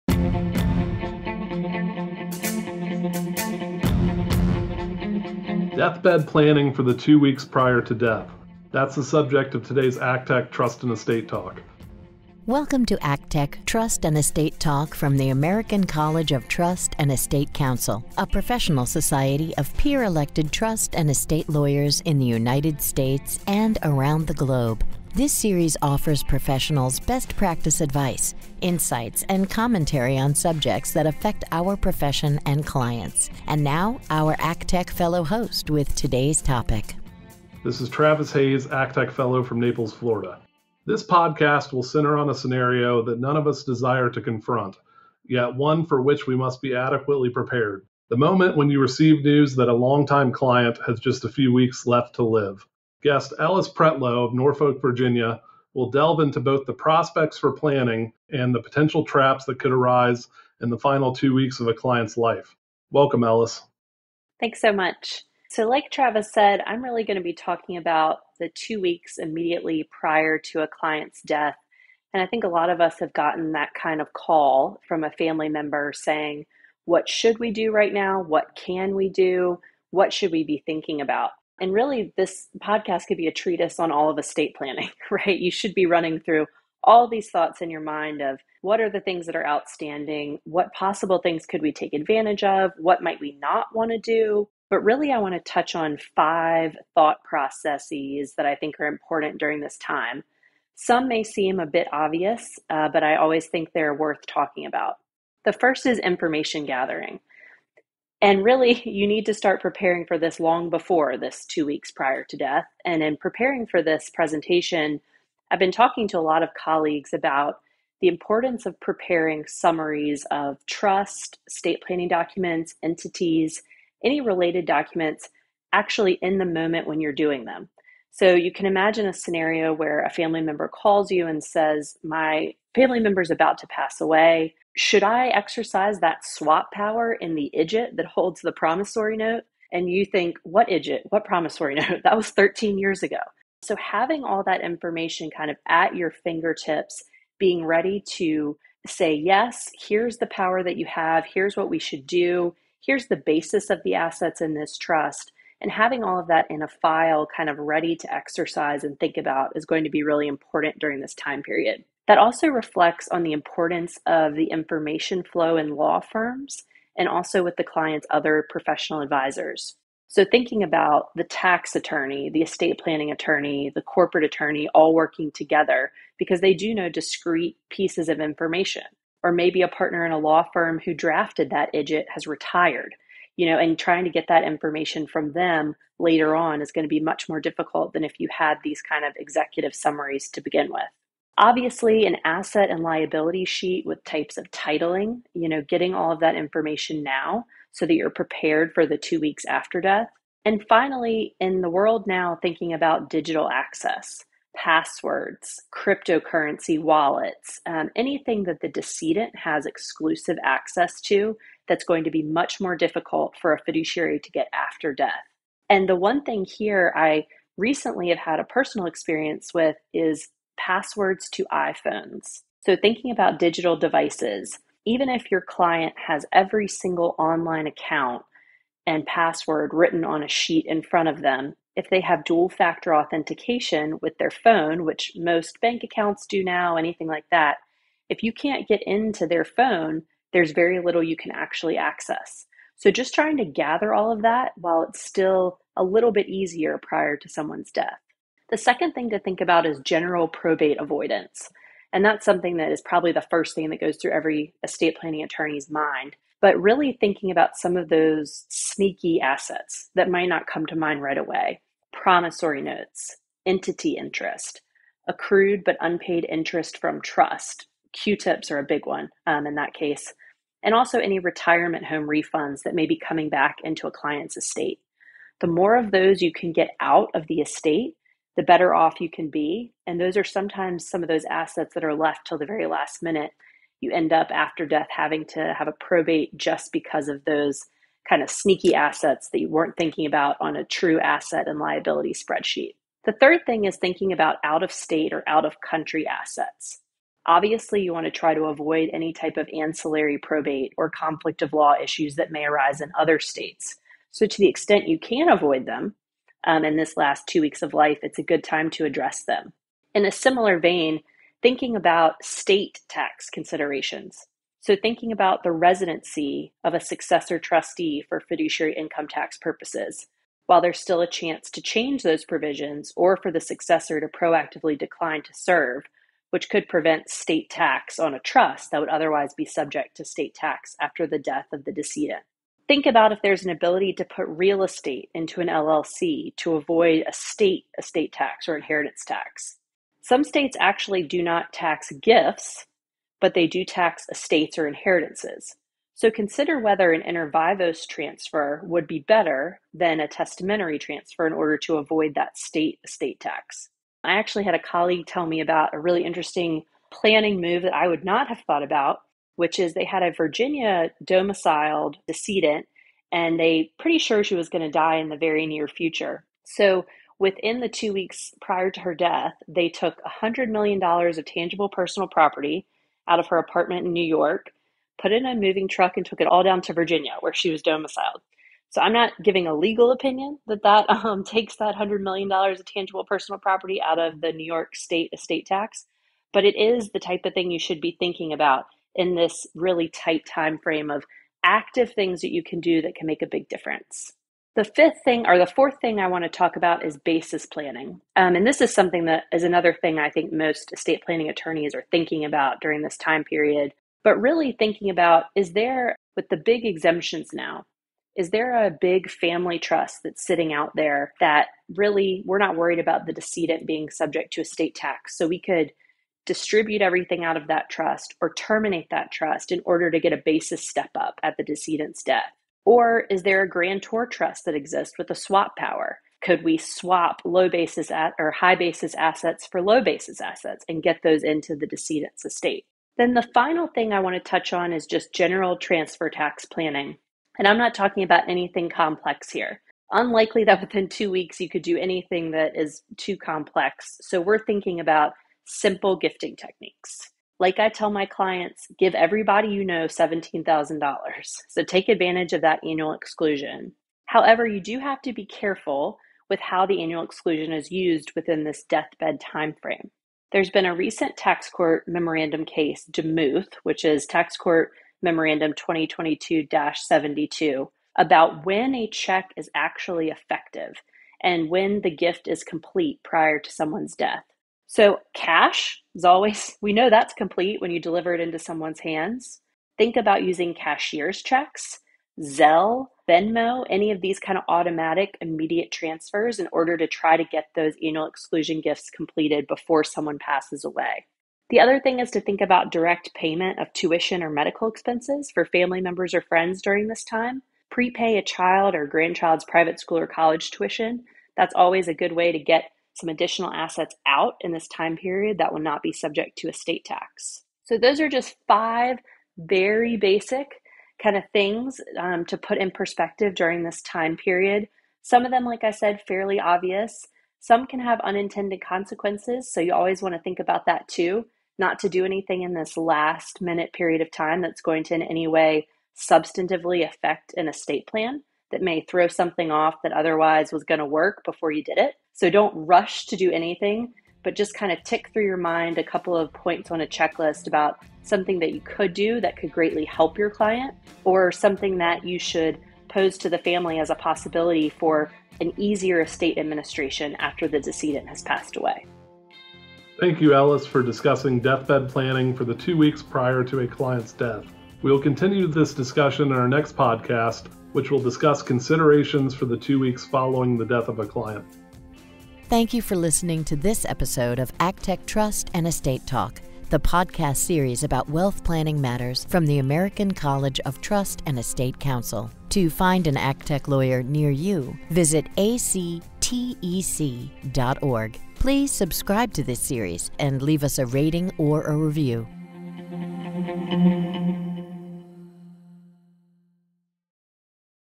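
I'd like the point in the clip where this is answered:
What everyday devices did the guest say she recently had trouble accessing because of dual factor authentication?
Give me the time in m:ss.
3:41.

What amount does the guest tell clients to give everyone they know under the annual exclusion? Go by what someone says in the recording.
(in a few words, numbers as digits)
$17,000.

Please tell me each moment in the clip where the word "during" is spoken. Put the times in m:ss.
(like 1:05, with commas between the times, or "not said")
1:39, 2:40, 6:42, 8:16, 8:33.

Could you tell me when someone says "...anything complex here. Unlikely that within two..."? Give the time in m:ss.
7:18.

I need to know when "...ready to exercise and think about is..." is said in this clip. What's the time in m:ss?
2:37.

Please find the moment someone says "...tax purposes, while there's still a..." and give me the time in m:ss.
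5:19.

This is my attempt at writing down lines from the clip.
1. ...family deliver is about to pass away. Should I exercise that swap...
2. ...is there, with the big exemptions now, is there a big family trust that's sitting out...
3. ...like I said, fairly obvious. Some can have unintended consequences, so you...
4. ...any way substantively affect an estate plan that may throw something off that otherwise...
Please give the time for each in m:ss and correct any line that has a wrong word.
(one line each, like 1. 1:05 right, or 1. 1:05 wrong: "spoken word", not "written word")
1. 2:12 wrong: "member", not "deliver"
2. 6:45 right
3. 8:35 right
4. 8:45 right.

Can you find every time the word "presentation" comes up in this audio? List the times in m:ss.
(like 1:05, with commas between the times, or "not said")
1:54.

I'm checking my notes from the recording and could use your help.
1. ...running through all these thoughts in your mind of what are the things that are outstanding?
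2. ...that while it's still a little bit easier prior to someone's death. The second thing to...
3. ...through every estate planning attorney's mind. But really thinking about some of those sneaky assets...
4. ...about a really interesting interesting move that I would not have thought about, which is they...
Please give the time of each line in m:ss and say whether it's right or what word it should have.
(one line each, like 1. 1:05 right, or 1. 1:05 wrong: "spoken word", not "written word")
1. 1:25 right
2. 4:04 right
3. 4:13 right
4. 5:55 wrong: "planning", not "interesting".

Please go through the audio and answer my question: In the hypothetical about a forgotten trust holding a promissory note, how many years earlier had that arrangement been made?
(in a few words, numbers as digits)
13.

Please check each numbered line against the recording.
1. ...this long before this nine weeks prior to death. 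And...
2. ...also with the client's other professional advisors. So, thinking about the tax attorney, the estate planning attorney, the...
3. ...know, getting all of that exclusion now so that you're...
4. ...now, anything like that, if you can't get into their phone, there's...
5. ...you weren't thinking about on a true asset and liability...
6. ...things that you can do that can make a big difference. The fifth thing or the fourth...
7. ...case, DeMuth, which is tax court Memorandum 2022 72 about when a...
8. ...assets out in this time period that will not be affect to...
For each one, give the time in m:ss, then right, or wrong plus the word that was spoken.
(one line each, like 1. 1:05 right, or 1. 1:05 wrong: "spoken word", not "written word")
1. 1:50 wrong: "two", not "nine"
2. 2:47 right
3. 3:15 wrong: "information", not "exclusion"
4. 3:56 right
5. 4:49 right
6. 6:31 right
7. 7:42 right
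8. 8:23 wrong: "subject", not "affect".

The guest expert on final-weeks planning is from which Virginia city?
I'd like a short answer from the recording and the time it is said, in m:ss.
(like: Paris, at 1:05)
Norfolk, at 0:54.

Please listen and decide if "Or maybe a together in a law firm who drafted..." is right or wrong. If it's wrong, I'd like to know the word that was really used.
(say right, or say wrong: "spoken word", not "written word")
wrong: "partner", not "together".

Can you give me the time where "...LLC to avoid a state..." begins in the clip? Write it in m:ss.
5:35.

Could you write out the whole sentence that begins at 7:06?
Could we swap low basis at, or high basis assets for low basis assets and get those into the decedent's estate?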